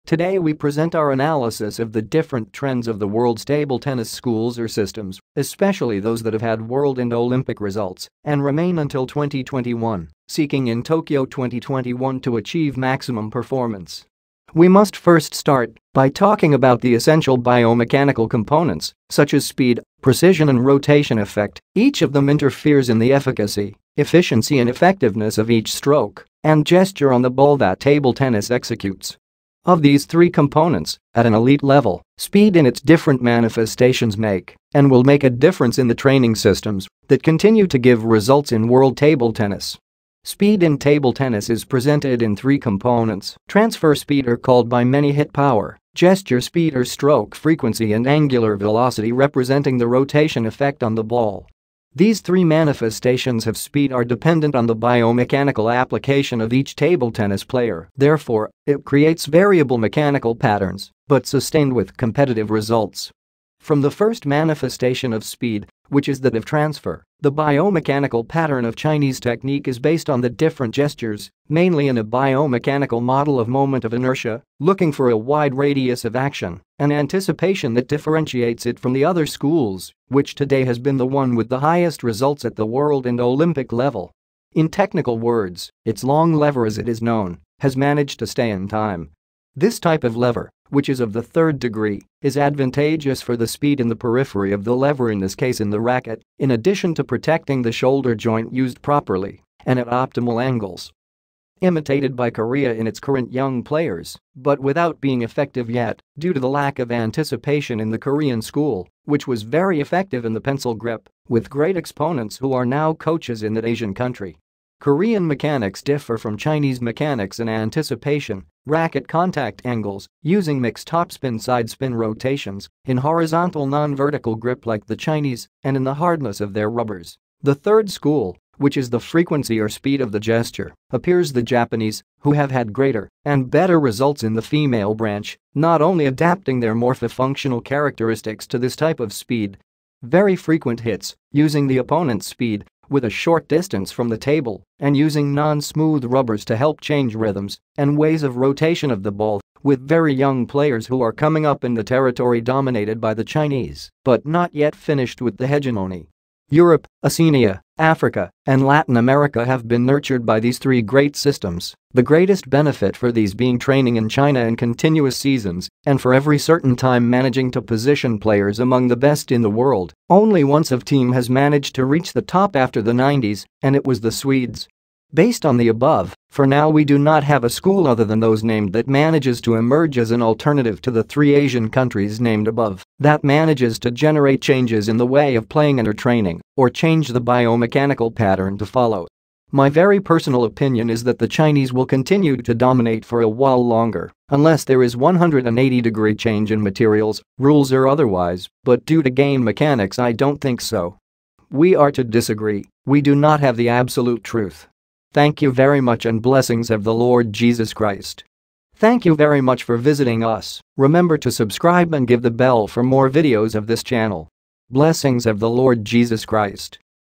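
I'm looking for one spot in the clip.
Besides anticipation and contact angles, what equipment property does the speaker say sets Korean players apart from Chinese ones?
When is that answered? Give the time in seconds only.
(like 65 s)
125 s.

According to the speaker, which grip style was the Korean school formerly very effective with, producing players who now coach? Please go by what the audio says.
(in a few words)
Pencil grip.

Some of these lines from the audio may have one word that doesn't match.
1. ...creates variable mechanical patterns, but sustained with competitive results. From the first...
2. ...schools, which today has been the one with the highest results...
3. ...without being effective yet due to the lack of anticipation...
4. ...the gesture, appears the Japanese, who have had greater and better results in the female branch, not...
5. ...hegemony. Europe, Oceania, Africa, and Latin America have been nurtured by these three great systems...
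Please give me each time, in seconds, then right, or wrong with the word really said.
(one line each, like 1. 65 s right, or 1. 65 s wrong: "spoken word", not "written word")
1. 58 s right
2. 79 s right
3. 104 s right
4. 130 s right
5. 155 s right.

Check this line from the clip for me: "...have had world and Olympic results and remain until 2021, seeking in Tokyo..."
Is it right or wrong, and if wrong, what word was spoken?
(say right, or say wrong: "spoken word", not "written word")
right.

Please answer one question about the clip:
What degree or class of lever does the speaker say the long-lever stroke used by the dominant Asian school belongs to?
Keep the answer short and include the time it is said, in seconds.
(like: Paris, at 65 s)
Third degree, at 91 s.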